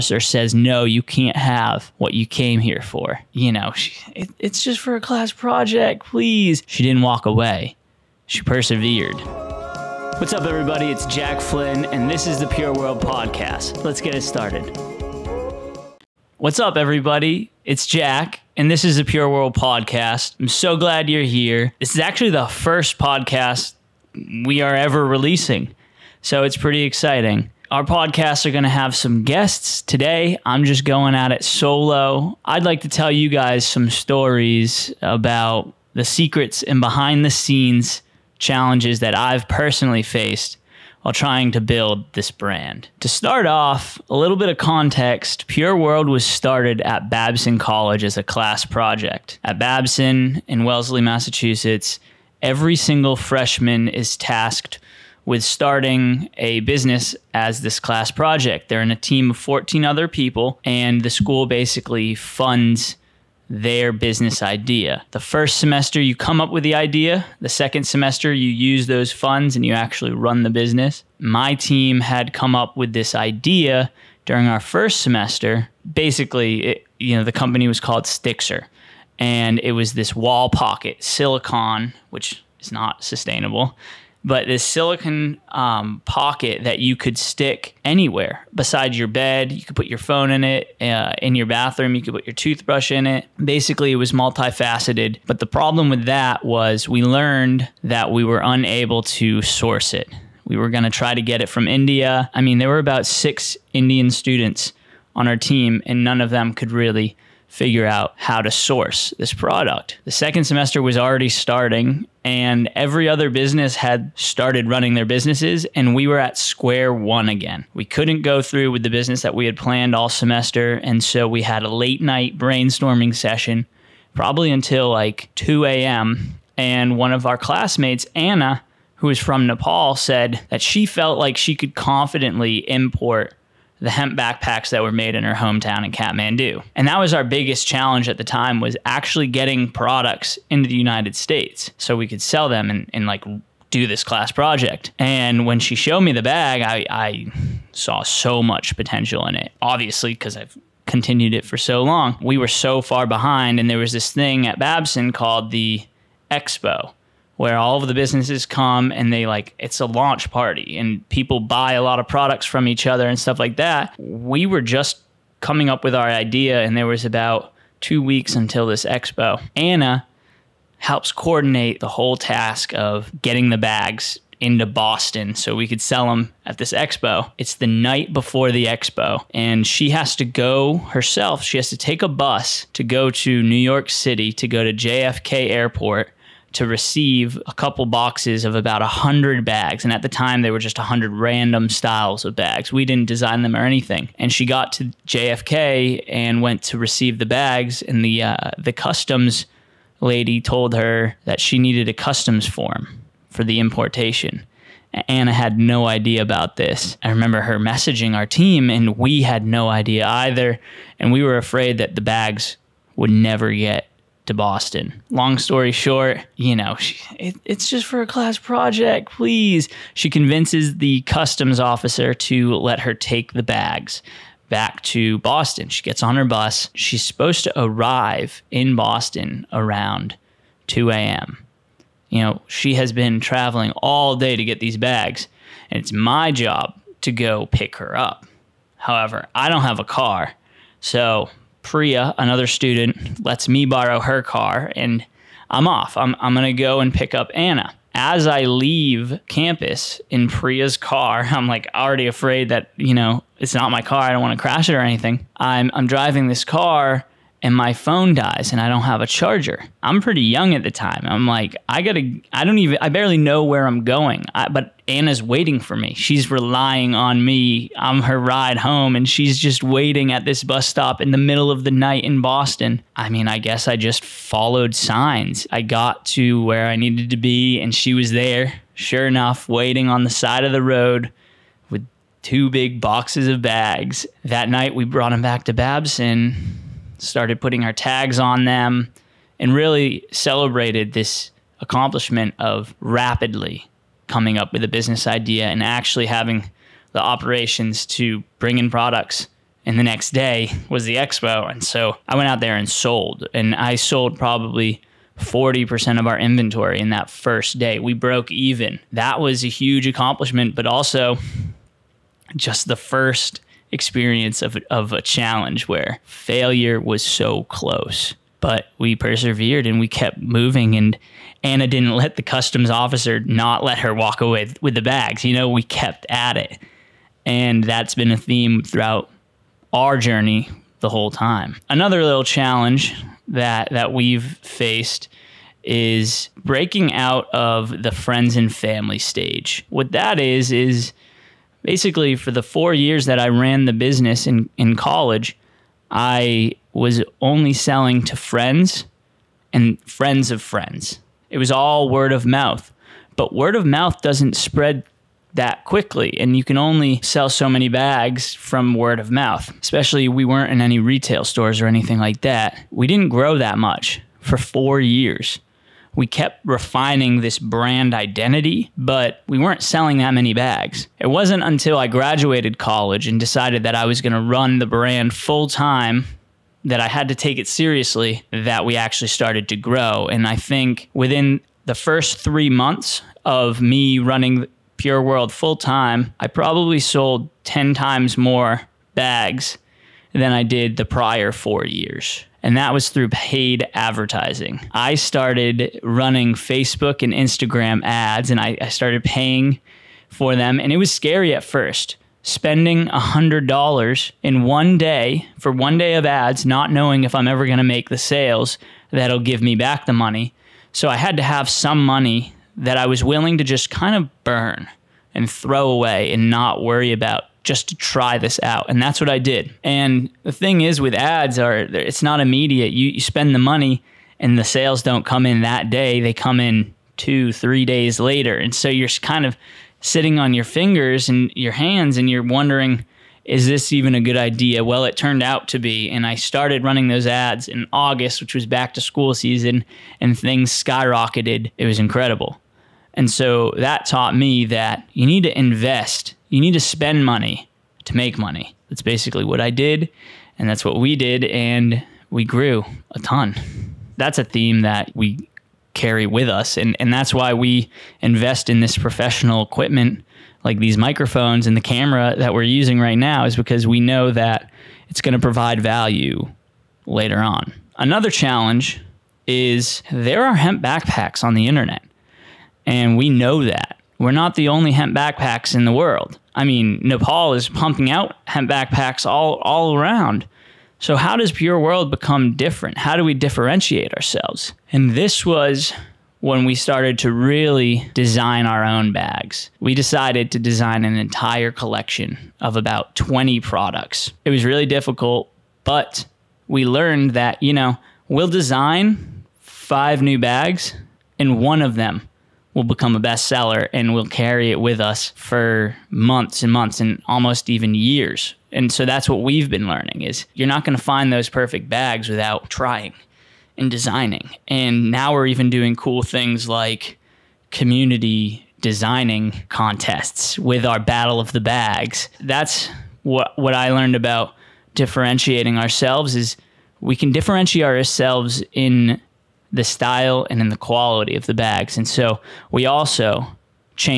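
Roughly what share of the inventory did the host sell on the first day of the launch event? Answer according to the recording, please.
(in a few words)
40%.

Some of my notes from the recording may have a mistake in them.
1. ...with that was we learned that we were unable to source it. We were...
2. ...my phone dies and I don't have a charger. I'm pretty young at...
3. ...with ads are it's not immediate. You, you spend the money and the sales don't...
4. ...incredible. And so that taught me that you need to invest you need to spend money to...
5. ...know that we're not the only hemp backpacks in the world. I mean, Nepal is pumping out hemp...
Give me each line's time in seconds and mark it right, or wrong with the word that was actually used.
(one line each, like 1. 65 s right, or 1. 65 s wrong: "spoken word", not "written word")
1. 95 s right
2. 257 s right
3. 420 s right
4. 441 s right
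5. 473 s right.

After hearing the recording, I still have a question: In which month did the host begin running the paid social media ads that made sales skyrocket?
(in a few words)
August.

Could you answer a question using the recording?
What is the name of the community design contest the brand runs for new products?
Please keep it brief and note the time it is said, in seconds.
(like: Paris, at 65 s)
battle of the bags, at 520 s.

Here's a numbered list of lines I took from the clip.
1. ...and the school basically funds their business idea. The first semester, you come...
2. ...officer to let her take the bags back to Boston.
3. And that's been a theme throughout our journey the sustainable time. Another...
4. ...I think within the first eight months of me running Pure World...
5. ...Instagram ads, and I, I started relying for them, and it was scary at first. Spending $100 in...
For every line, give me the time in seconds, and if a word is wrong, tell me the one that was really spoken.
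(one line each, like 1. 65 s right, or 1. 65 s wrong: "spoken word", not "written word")
1. 60 s right
2. 221 s right
3. 327 s wrong: "whole", not "sustainable"
4. 380 s wrong: "three", not "eight"
5. 397 s wrong: "paying", not "relying".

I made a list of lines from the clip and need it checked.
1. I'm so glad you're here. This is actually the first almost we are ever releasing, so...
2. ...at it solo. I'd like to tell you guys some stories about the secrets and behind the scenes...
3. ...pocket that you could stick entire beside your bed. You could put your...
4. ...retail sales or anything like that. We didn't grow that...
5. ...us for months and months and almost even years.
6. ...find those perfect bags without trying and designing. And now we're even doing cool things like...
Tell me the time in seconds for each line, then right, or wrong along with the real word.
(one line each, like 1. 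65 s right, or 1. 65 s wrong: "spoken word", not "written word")
1. 20 s wrong: "podcast", not "almost"
2. 31 s right
3. 86 s wrong: "anywhere", not "entire"
4. 360 s wrong: "stores", not "sales"
5. 504 s right
6. 510 s right.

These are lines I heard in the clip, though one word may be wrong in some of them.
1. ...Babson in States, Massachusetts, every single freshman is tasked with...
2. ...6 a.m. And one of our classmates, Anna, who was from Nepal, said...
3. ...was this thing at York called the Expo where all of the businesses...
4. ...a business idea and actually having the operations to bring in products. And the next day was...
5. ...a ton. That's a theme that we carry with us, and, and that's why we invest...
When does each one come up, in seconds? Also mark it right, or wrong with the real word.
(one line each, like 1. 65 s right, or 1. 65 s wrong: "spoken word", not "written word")
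1. 49 s wrong: "Wellesley", not "States"
2. 125 s wrong: "2", not "6"
3. 153 s wrong: "Babson", not "York"
4. 294 s right
5. 452 s right.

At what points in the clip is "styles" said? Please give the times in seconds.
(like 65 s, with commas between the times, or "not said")
191 s, 529 s.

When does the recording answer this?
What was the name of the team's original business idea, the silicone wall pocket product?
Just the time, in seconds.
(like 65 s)
78 s.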